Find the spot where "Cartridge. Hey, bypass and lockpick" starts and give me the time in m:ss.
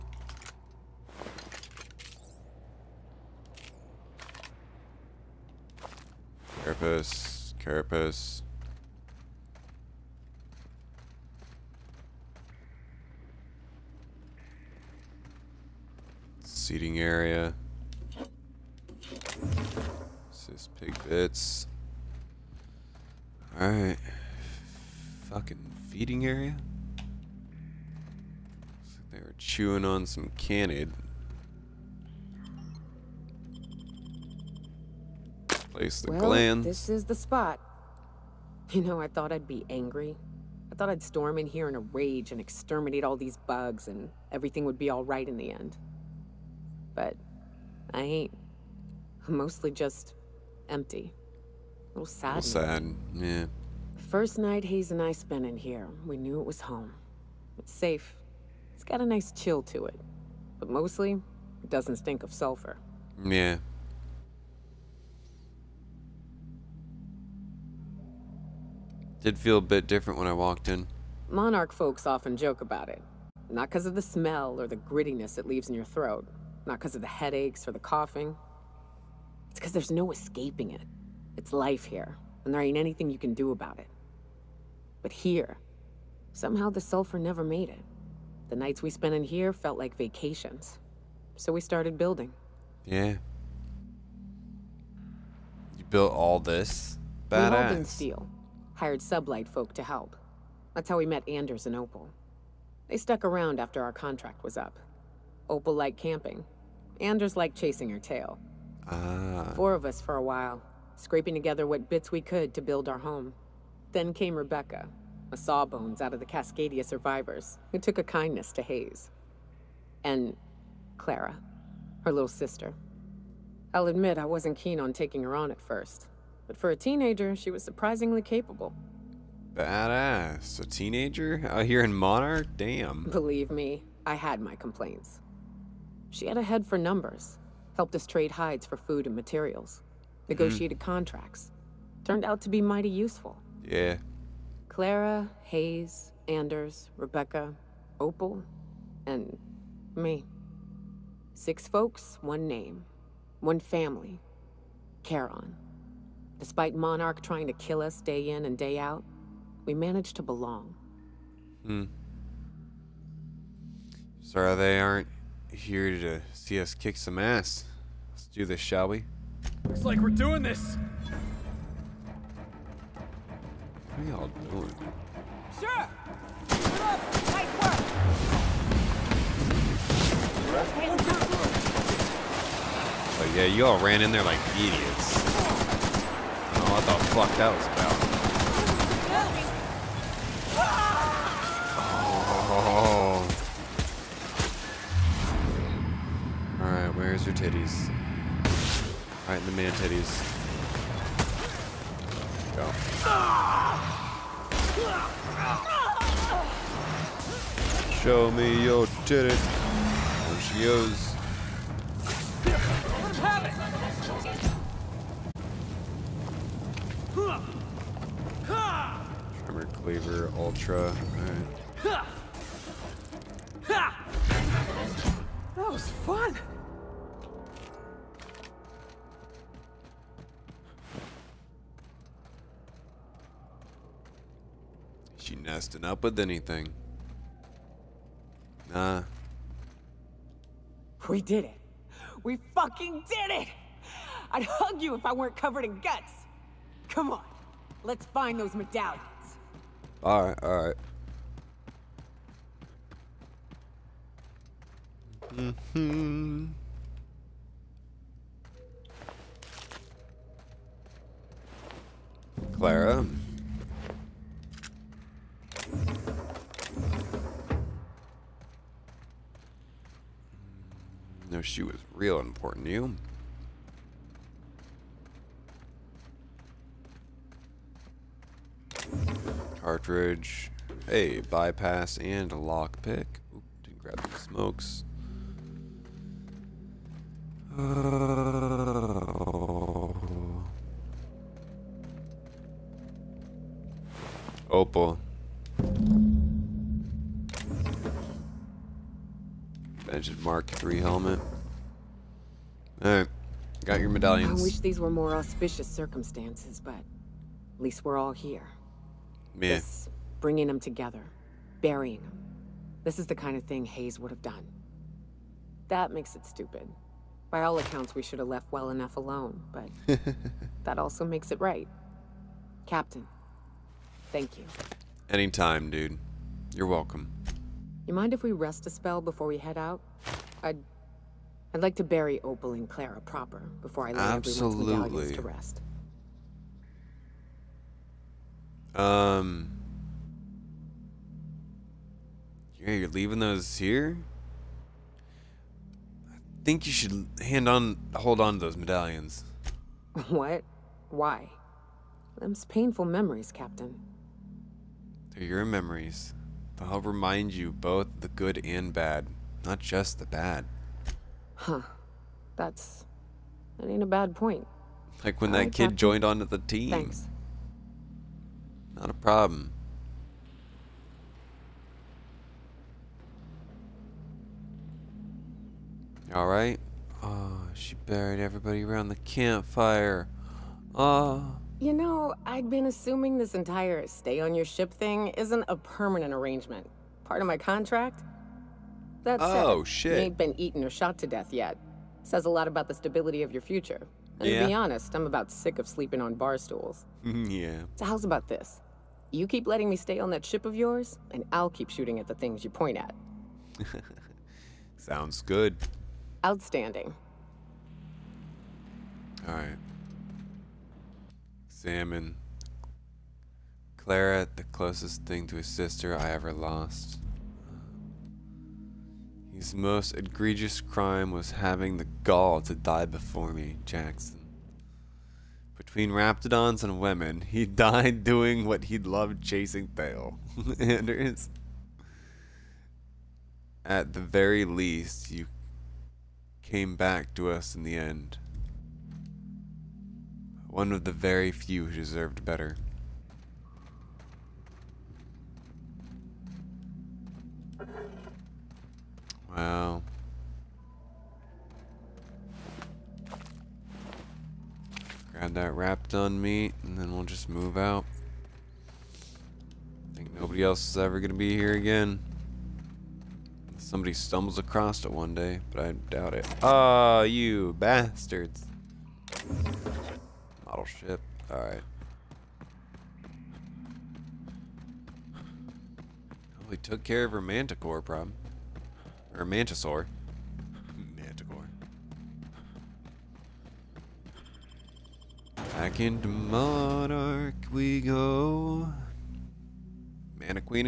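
4:39.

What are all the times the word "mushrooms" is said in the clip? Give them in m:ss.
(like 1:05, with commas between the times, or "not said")
not said.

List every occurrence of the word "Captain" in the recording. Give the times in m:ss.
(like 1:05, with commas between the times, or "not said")
5:22, 5:53, 6:05.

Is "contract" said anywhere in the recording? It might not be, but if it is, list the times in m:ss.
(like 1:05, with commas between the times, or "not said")
1:43, 2:20, 6:27.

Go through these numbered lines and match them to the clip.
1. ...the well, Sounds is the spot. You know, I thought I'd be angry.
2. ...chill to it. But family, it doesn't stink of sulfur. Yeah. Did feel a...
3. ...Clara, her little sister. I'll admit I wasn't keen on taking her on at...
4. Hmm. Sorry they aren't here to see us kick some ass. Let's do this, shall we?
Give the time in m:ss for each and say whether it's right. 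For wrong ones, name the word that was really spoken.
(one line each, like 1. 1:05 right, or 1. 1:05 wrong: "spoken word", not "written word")
1. 0:36 wrong: "This", not "Sounds"
2. 0:59 wrong: "mostly", not "family"
3. 2:00 right
4. 2:41 right.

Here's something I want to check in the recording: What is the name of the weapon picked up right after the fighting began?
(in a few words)
Tremor Cleaver Ultra.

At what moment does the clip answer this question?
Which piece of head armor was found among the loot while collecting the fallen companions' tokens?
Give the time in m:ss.
4:59.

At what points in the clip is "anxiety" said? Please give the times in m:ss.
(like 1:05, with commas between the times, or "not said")
not said.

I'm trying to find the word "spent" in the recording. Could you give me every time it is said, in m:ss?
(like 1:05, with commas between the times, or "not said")
0:55, 1:28.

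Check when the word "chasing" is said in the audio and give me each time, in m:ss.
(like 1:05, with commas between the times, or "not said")
1:47, 7:09.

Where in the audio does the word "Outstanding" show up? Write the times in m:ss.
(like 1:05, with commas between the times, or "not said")
6:46.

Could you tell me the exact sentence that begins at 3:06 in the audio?
I thought, fuck that was about.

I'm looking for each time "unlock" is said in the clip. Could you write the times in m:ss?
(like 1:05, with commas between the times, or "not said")
not said.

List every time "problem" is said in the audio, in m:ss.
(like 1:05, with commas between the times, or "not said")
6:08, 7:57.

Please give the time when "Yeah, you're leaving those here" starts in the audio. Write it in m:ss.
5:42.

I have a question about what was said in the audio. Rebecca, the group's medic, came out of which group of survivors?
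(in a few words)
Cascadia survivors.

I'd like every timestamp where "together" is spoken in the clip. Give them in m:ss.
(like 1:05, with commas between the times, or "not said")
1:51, 5:10.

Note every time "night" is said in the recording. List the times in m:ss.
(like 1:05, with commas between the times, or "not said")
0:54, 1:28.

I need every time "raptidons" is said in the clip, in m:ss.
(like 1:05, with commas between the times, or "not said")
7:05, 7:35.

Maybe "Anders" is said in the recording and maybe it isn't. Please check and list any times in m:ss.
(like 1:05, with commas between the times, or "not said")
1:41, 1:47, 2:26, 7:10.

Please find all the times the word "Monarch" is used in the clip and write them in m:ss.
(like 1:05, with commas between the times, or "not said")
1:11, 2:11, 2:36, 8:06.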